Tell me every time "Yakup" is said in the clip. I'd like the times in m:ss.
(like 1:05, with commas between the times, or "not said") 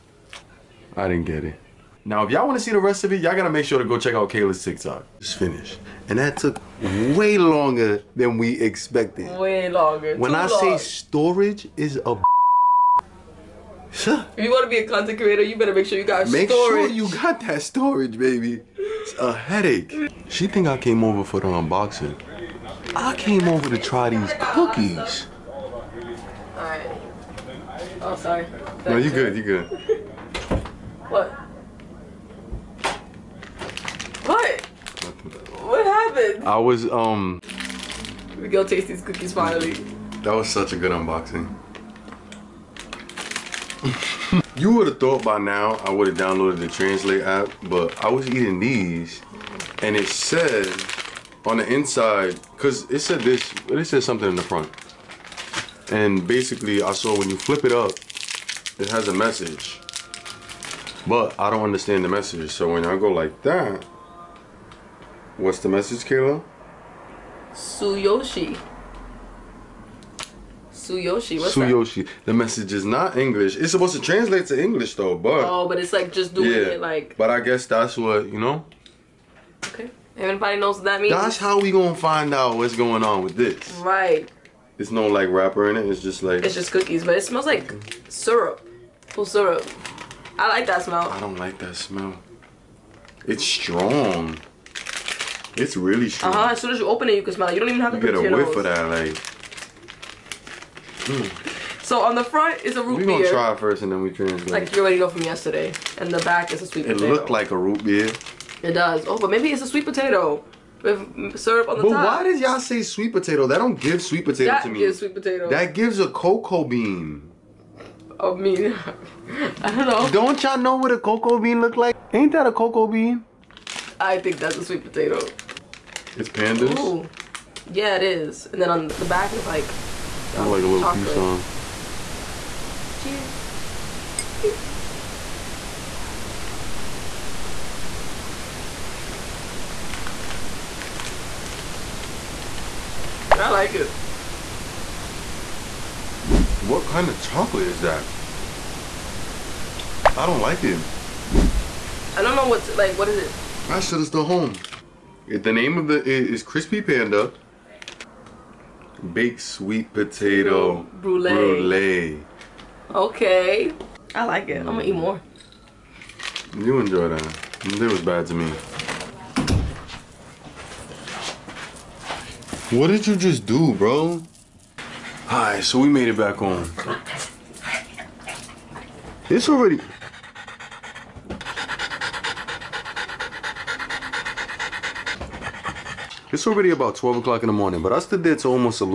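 not said.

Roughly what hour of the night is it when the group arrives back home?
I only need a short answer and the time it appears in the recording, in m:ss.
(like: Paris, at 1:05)
12 o'clock, at 3:06.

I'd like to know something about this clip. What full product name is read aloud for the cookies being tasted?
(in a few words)
Crispy Panda baked sweet potato brulee.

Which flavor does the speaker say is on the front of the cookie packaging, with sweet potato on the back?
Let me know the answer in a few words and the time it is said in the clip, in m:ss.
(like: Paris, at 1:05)
Root beer, at 1:42.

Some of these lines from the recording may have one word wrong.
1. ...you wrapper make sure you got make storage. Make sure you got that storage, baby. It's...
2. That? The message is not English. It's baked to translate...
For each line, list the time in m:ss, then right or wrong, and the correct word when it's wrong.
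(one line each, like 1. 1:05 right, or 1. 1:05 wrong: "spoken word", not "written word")
1. 0:15 wrong: "better", not "wrapper"
2. 1:12 wrong: "supposed", not "baked".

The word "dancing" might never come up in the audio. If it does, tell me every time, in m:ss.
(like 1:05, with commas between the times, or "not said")
not said.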